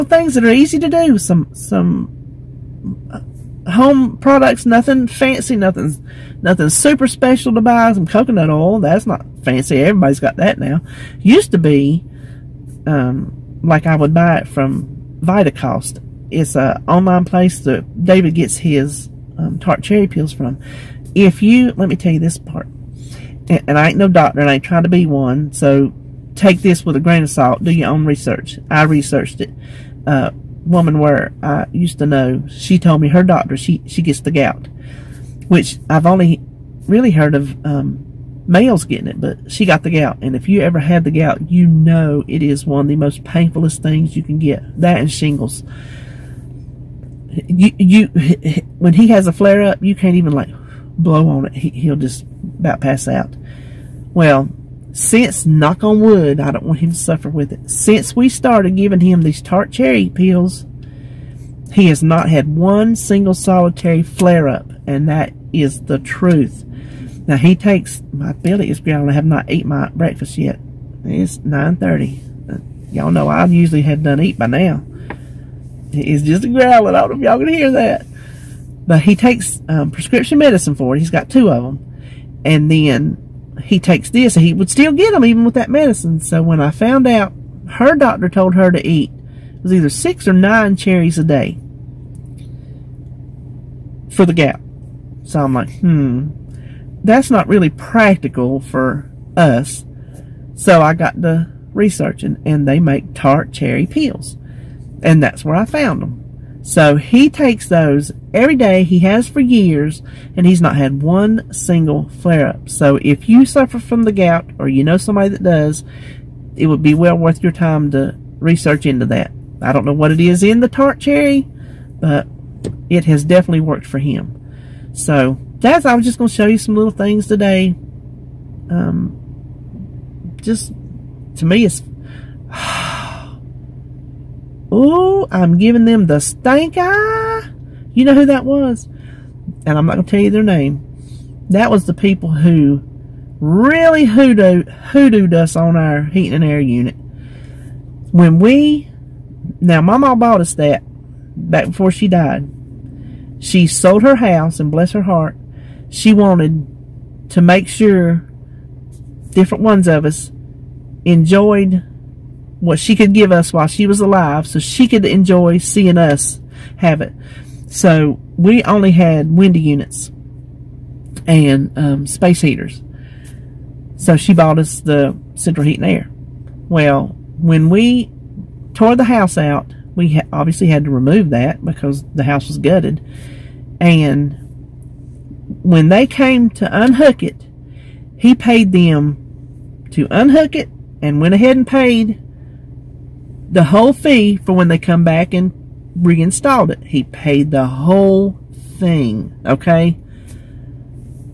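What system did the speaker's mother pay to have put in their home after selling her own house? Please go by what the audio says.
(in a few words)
Central heat and air.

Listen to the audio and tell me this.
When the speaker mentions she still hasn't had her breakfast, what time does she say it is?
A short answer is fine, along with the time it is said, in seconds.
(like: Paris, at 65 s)
9:30, at 71 s.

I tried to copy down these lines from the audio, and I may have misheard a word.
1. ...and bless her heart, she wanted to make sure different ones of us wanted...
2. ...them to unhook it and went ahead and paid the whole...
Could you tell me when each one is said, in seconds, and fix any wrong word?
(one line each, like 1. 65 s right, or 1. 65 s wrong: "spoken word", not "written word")
1. 154 s wrong: "enjoyed", not "wanted"
2. 188 s right.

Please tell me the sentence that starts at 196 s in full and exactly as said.
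He paid the whole thing, okay?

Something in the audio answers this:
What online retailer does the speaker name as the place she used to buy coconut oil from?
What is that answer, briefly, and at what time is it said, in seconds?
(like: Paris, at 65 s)
Vitacost, at 15 s.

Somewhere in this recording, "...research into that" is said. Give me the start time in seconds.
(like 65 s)
118 s.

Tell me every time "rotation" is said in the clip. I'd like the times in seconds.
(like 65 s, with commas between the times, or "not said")
not said.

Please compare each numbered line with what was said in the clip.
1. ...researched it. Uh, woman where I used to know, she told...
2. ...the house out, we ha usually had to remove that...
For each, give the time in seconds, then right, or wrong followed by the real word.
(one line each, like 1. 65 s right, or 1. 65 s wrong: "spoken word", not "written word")
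1. 28 s right
2. 178 s wrong: "obviously", not "usually".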